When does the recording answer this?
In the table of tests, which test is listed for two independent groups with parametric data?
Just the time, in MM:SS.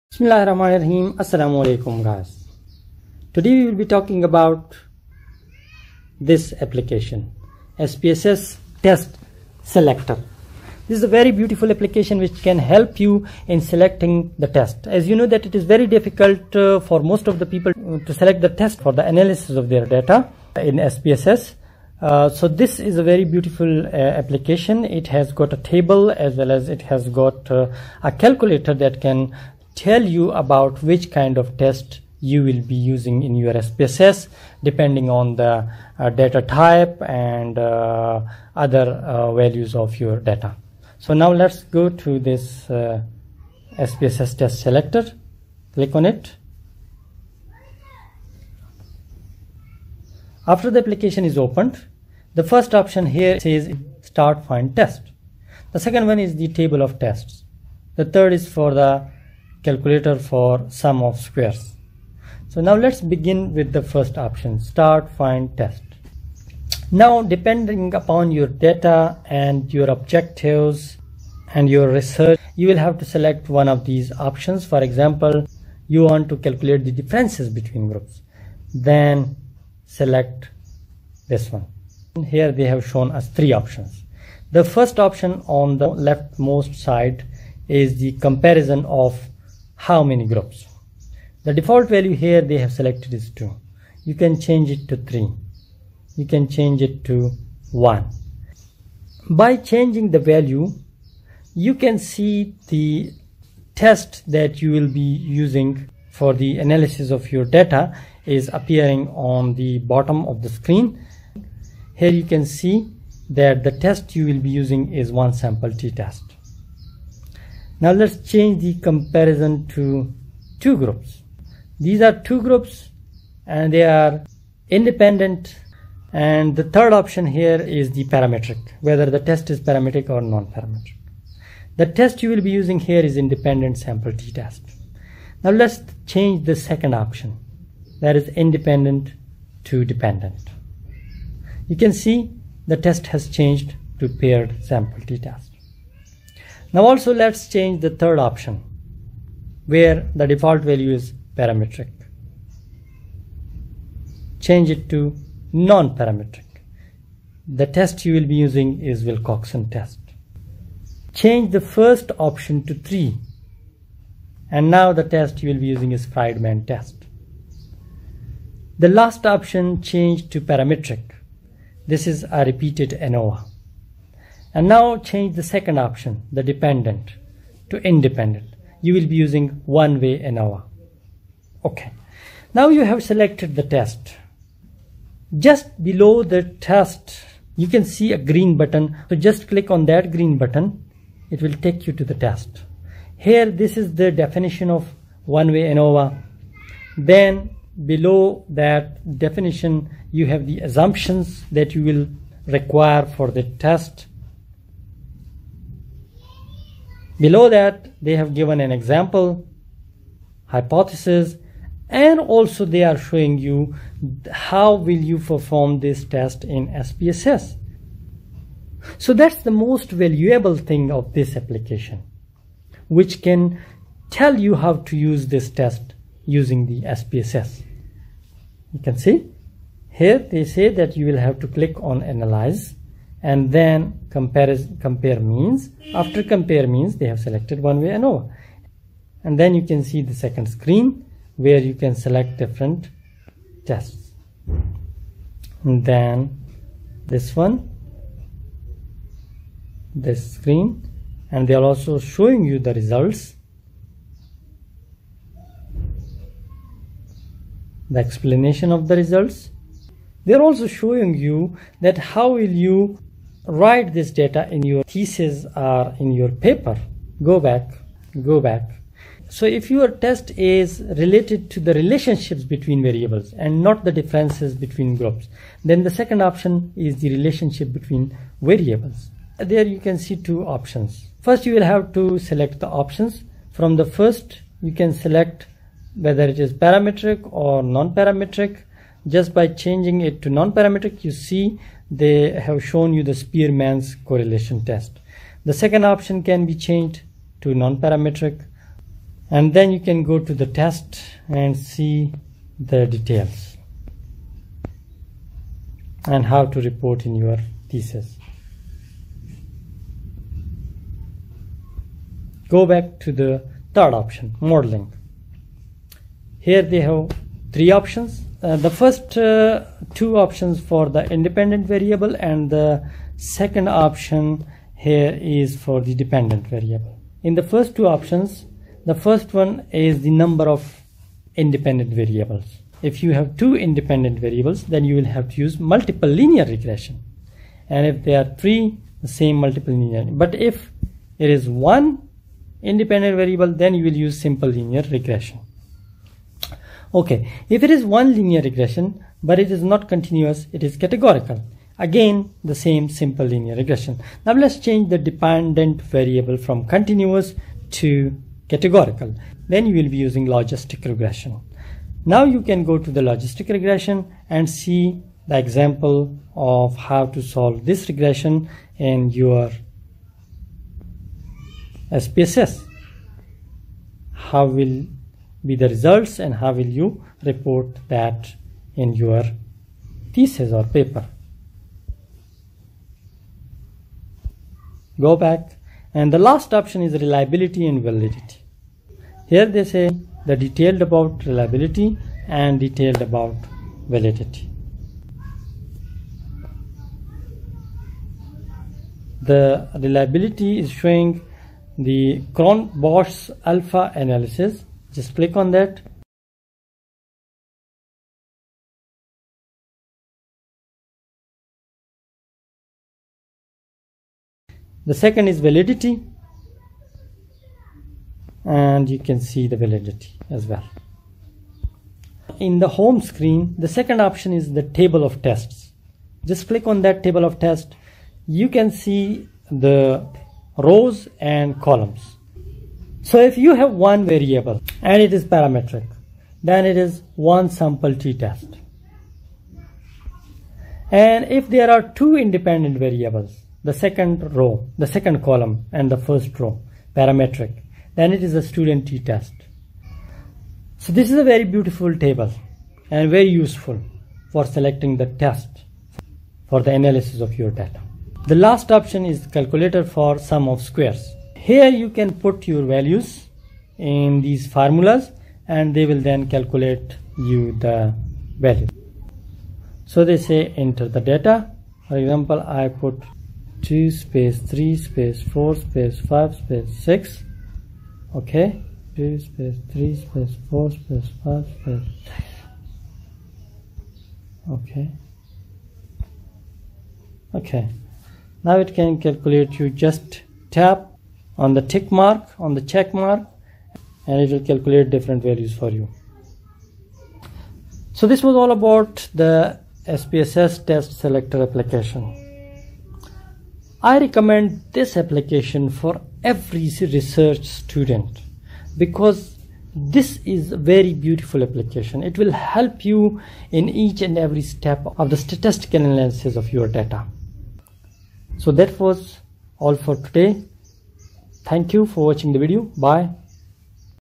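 07:28.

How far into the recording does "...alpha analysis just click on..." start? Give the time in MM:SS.
06:43.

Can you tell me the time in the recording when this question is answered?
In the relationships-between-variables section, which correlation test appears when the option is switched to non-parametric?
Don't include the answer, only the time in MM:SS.
04:53.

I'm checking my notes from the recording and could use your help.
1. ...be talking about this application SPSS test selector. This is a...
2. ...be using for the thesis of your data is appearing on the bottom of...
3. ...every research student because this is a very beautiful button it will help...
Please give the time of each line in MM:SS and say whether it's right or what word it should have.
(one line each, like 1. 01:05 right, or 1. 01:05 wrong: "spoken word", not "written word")
1. 00:03 right
2. 01:44 wrong: "analysis", not "thesis"
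3. 08:26 wrong: "application", not "button".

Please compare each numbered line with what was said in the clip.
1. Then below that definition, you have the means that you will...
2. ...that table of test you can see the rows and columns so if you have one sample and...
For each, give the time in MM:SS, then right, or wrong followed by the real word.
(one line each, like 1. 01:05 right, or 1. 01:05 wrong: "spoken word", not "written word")
1. 03:16 wrong: "assumptions", not "means"
2. 07:06 wrong: "variable", not "sample".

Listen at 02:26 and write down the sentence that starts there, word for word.
Now also let's change the third option where the default value is parametric.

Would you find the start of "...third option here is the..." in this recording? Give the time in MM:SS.
02:06.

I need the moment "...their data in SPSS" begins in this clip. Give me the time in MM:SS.
00:19.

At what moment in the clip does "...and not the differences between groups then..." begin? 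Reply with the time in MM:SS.
04:33.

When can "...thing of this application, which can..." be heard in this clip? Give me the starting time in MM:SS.
03:40.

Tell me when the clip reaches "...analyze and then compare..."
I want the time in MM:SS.
03:52.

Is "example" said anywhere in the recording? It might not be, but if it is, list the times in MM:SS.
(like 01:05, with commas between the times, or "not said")
01:14, 03:28, 06:05, 07:52.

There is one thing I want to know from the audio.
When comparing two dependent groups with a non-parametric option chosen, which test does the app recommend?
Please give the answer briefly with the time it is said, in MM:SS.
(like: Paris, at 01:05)
Wilcoxon test, at 02:39.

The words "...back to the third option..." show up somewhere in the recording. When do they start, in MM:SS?
05:12.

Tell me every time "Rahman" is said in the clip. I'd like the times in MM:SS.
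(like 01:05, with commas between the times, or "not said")
00:00.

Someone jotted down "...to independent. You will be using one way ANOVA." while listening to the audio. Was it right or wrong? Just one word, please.
right.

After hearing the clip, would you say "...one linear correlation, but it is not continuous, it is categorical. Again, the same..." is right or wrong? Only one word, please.
wrong.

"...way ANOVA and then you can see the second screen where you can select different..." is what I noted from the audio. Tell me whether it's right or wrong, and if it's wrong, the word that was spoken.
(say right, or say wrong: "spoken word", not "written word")
right.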